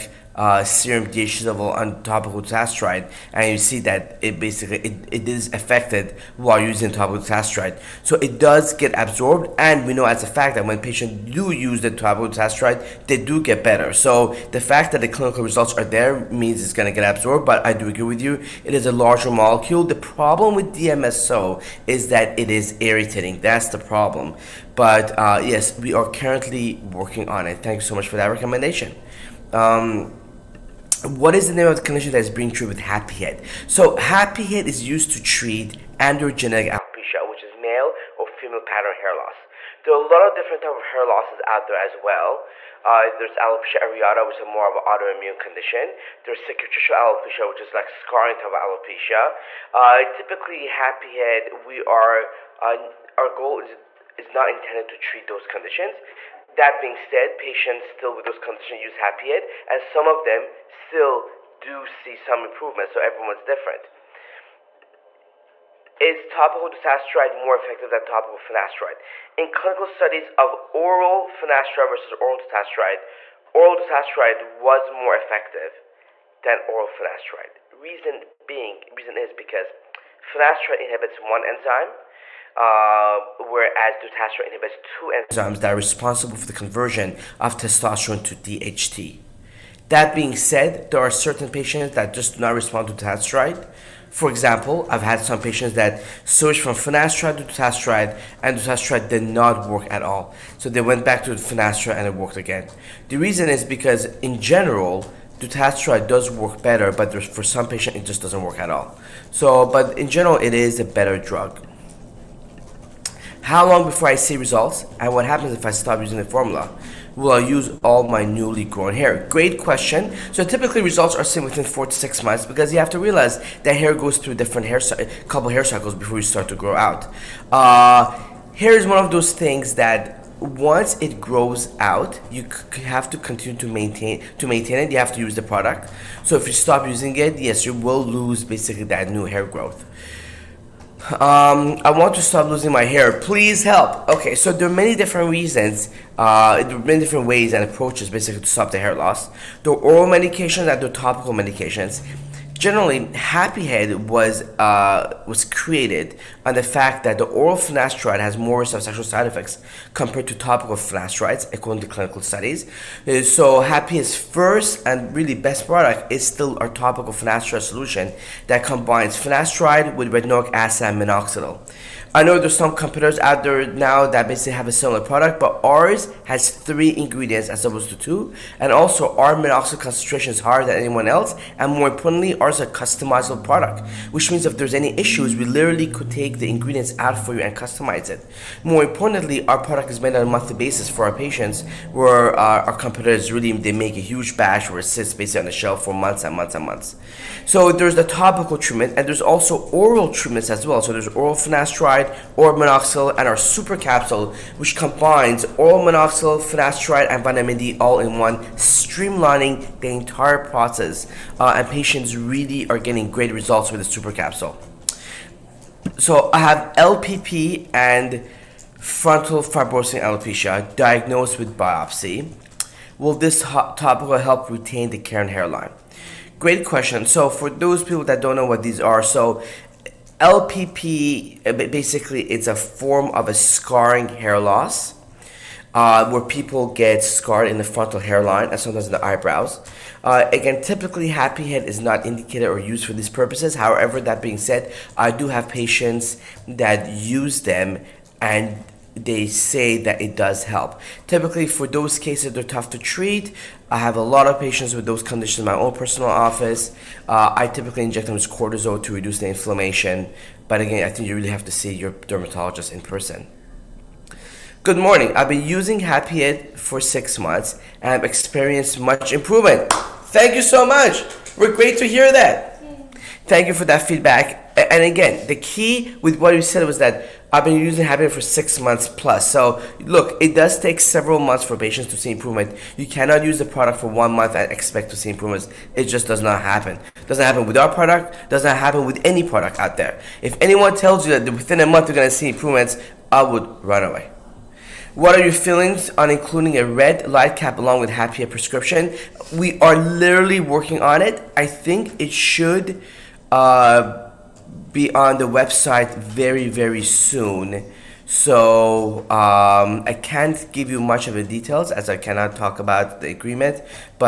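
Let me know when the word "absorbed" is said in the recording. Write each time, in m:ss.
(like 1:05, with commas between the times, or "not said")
0:08, 0:17.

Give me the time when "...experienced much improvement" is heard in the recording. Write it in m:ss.
4:28.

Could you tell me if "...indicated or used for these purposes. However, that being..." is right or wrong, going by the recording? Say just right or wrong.
right.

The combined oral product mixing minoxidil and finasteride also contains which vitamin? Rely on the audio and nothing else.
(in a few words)
vitamin D.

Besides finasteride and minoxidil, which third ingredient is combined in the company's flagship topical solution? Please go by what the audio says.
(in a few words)
retinoic acid.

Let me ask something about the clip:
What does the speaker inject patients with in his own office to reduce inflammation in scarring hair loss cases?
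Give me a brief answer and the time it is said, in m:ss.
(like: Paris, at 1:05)
cortisol, at 4:18.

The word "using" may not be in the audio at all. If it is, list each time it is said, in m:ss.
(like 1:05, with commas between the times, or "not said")
0:06, 1:55, 2:16, 4:25, 4:37.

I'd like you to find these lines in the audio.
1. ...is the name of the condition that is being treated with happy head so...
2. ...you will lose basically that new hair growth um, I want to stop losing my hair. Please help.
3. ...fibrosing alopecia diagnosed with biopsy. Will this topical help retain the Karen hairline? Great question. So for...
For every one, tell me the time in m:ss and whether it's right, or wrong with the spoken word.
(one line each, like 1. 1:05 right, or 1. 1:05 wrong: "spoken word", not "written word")
1. 0:31 right
2. 2:17 right
3. 3:39 right.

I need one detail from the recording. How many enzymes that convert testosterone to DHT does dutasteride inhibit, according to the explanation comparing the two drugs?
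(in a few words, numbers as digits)
2.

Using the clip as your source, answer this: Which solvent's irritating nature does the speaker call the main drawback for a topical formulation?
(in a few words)
DMSO.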